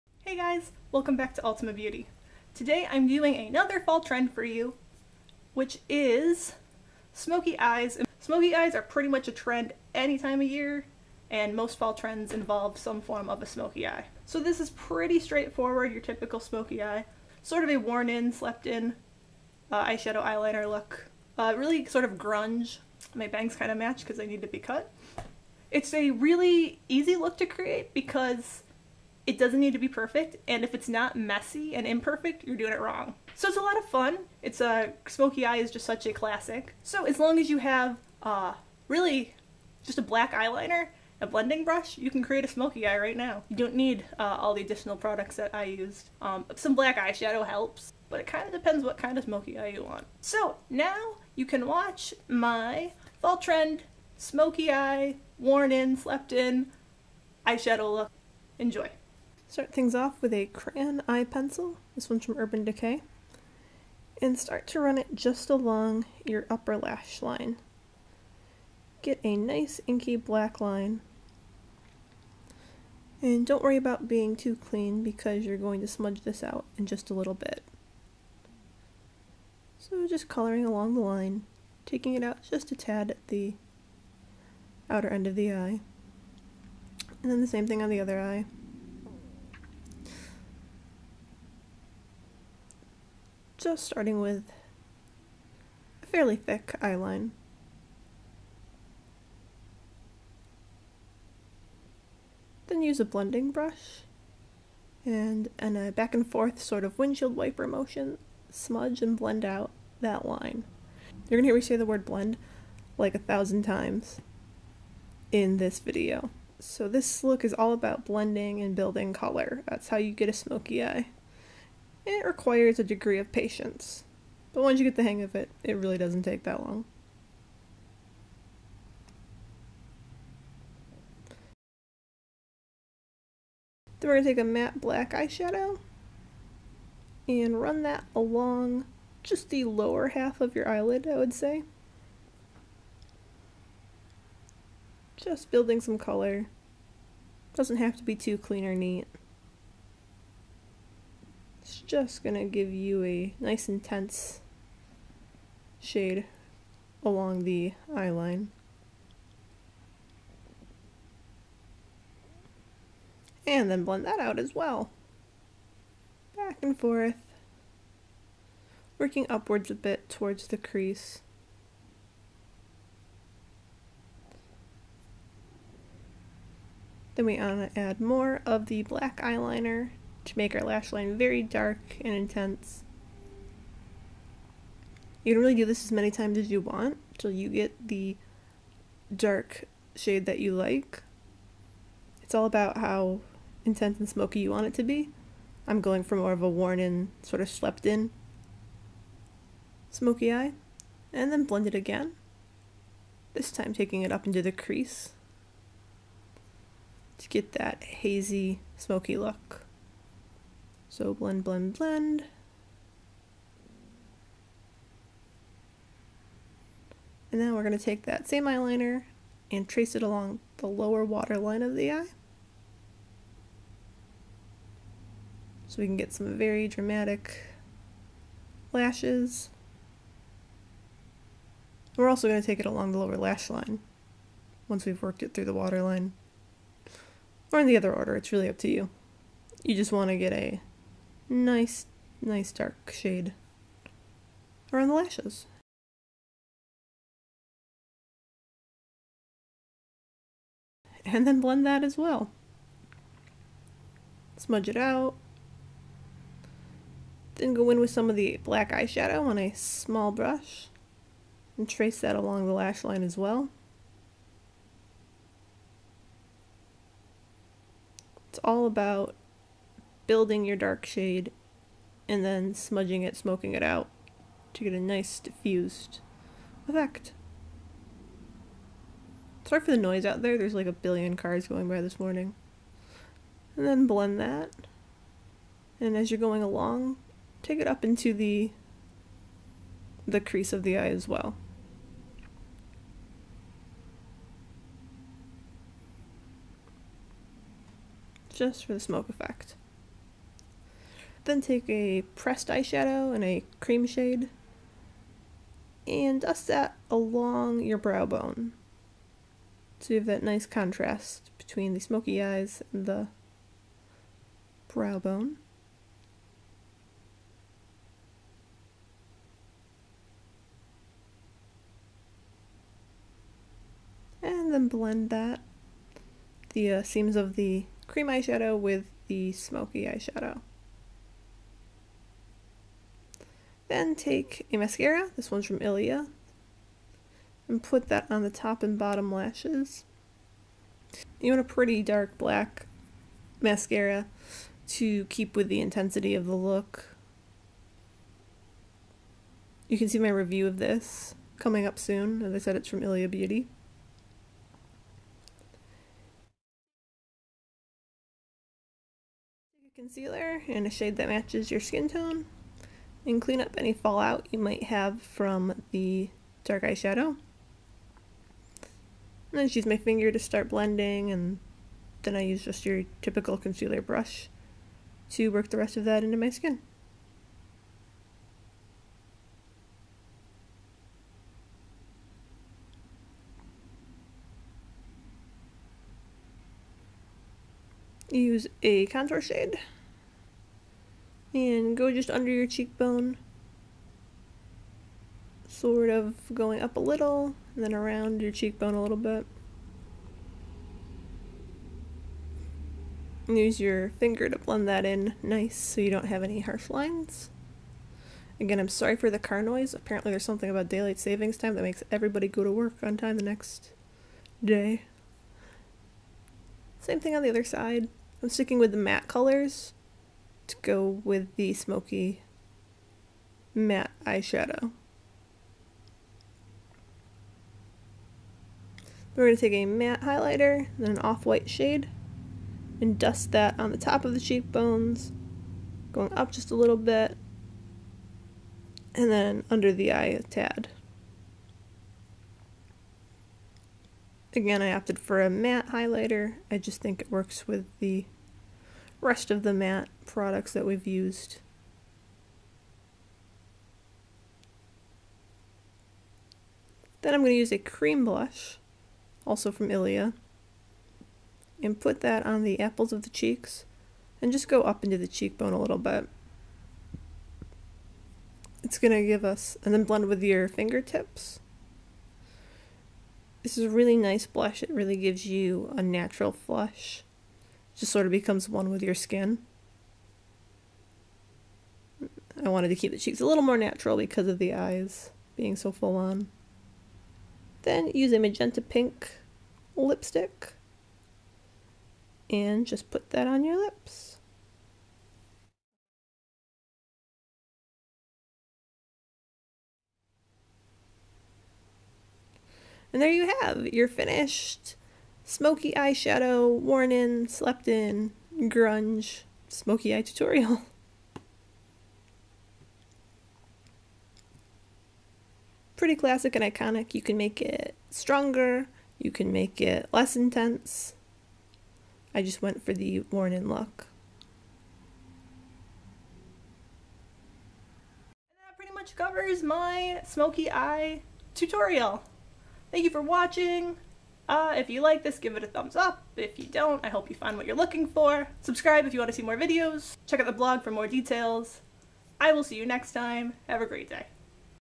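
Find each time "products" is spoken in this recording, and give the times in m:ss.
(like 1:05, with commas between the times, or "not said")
0:44, 7:30.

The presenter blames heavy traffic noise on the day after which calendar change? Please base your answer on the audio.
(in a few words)
daylight savings time.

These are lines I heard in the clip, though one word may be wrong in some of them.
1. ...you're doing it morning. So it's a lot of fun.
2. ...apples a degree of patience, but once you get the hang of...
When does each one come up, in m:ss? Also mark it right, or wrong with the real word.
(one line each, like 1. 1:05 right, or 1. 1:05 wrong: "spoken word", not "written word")
1. 0:32 wrong: "wrong", not "morning"
2. 2:02 wrong: "requires", not "apples".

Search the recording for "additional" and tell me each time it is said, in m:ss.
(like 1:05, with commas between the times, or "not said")
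0:44.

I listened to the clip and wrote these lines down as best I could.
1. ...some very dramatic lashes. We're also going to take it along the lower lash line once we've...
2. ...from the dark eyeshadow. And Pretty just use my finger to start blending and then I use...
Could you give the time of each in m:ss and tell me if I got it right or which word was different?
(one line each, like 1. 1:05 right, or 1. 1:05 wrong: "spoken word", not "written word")
1. 3:46 right
2. 6:05 wrong: "Then", not "Pretty".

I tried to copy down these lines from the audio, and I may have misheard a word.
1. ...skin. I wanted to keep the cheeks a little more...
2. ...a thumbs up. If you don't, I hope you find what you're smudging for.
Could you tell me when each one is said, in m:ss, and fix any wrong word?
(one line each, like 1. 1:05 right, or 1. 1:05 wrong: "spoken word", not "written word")
1. 7:58 right
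2. 8:55 wrong: "looking", not "smudging".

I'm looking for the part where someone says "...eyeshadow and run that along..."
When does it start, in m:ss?
2:15.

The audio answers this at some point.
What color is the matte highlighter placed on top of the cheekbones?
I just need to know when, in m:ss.
7:10.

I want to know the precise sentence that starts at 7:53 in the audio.
This is a really nice blush.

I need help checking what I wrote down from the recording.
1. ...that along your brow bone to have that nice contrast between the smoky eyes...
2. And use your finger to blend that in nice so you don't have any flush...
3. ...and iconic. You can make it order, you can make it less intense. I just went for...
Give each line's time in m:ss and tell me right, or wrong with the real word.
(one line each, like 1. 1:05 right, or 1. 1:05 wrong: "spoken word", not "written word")
1. 5:06 right
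2. 6:43 wrong: "harsh", not "flush"
3. 8:36 wrong: "stronger", not "order".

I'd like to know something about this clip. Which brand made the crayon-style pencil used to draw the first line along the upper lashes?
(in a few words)
Urban Decay.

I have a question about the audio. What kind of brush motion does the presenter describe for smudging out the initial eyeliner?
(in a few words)
windshield wiper motion.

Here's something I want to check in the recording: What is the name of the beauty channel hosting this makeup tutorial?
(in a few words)
Ultima Beauty.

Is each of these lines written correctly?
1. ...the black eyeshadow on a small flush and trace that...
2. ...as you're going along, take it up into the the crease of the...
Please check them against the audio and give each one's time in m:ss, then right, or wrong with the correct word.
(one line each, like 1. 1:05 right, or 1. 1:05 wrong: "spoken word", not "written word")
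1. 4:18 wrong: "brush", not "flush"
2. 4:45 right.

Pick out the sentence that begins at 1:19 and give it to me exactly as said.
So just coloring along the line, taking it out just a tad at the outer end of the eye.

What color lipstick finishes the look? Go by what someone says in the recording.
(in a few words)
magenta pink.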